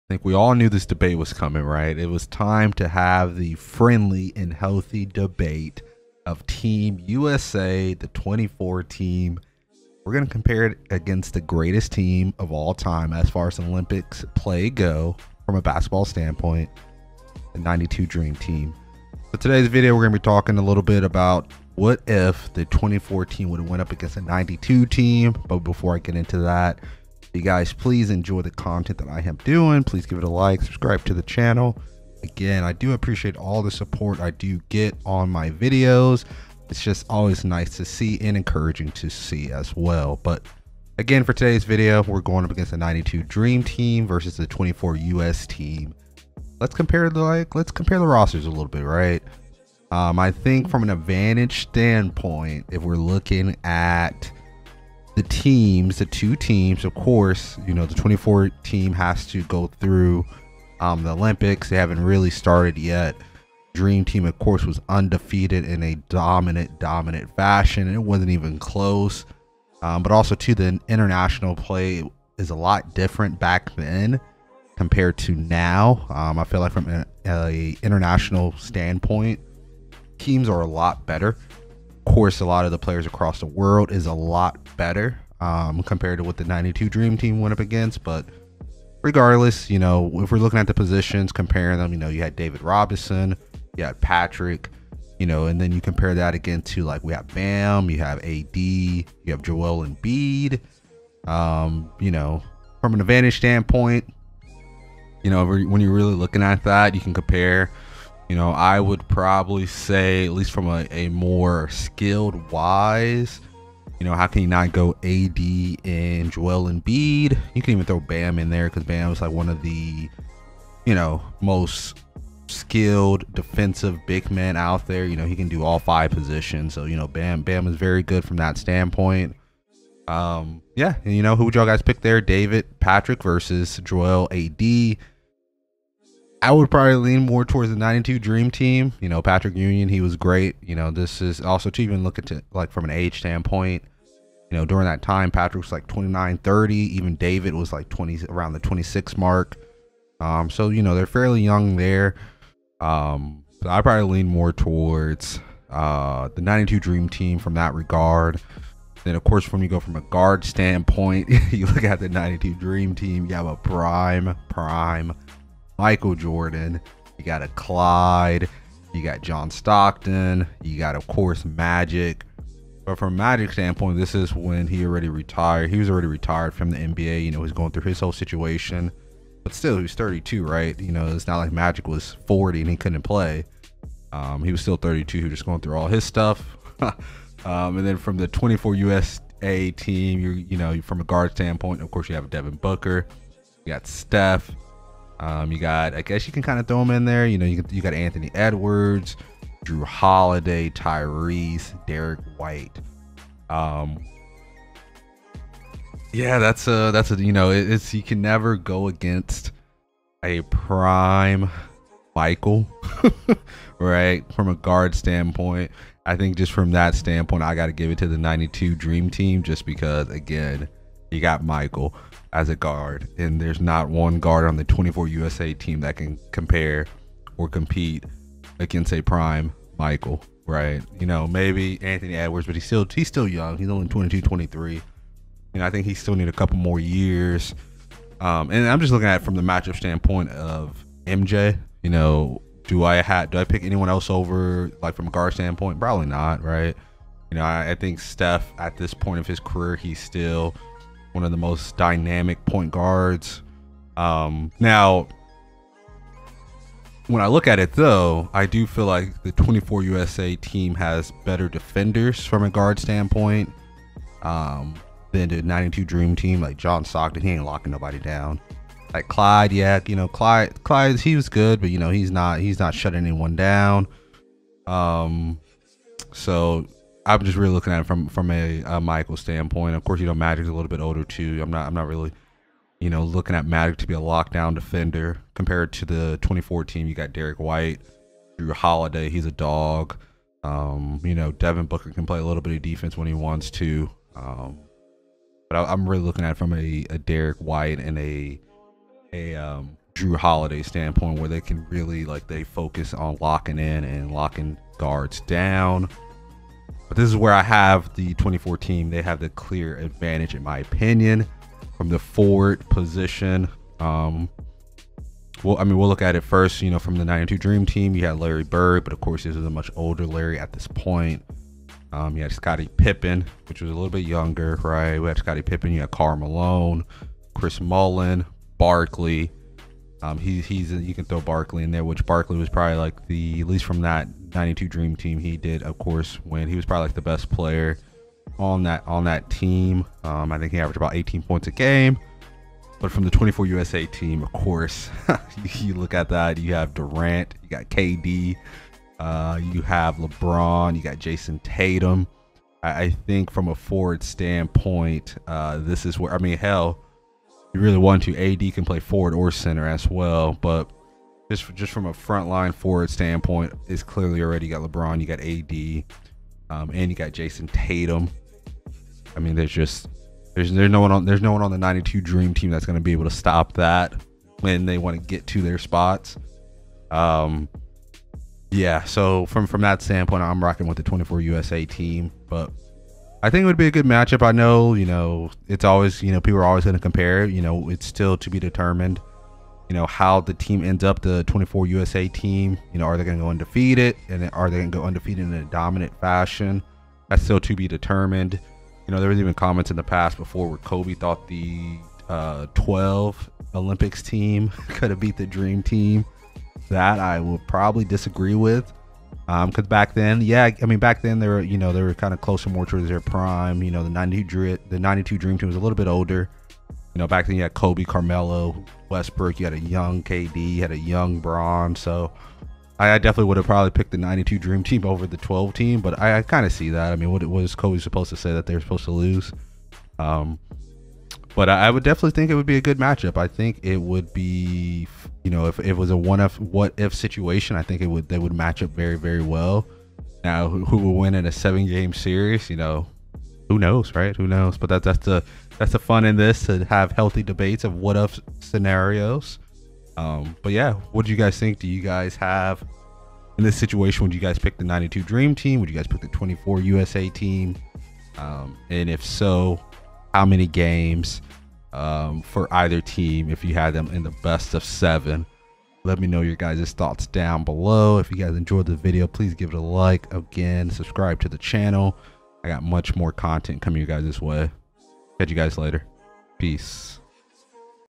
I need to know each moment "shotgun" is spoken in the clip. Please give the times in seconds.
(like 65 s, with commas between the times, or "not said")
not said.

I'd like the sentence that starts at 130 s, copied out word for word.
Um, yeah, and you know, who would y'all guys pick there?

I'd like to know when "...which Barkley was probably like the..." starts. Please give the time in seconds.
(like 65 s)
331 s.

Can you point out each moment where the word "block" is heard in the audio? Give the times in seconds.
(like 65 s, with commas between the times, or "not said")
not said.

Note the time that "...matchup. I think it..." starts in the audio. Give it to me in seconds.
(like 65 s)
432 s.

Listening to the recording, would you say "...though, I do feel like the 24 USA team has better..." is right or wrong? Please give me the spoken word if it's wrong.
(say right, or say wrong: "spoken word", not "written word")
right.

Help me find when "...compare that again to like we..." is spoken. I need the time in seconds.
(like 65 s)
95 s.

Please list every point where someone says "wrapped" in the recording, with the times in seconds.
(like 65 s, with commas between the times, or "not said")
not said.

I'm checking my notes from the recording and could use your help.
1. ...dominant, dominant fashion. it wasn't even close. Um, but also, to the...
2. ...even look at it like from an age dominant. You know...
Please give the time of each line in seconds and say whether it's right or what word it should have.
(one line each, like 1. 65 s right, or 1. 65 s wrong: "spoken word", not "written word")
1. 66 s right
2. 141 s wrong: "standpoint", not "dominant".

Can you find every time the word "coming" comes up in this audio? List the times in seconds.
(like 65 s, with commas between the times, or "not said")
1 s, 473 s.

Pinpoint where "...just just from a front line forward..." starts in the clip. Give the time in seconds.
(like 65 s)
361 s.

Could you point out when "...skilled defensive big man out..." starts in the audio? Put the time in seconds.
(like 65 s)
122 s.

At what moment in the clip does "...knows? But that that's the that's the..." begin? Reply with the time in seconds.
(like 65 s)
444 s.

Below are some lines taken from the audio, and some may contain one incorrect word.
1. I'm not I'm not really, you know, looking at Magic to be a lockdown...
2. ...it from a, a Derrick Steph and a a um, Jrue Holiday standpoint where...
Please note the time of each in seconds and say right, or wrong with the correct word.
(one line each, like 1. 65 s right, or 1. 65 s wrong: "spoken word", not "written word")
1. 281 s right
2. 296 s wrong: "White", not "Steph".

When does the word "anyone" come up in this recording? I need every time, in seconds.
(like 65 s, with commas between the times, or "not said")
243 s, 272 s.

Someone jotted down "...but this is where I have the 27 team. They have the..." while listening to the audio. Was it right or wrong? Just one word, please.
wrong.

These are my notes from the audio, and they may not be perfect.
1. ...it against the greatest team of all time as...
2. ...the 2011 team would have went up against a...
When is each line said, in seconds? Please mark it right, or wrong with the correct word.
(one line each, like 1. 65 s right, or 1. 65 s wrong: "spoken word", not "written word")
1. 10 s right
2. 22 s wrong: "2014", not "2011".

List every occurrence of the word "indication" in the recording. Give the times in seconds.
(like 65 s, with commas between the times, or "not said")
not said.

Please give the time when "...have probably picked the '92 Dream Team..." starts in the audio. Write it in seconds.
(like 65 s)
423 s.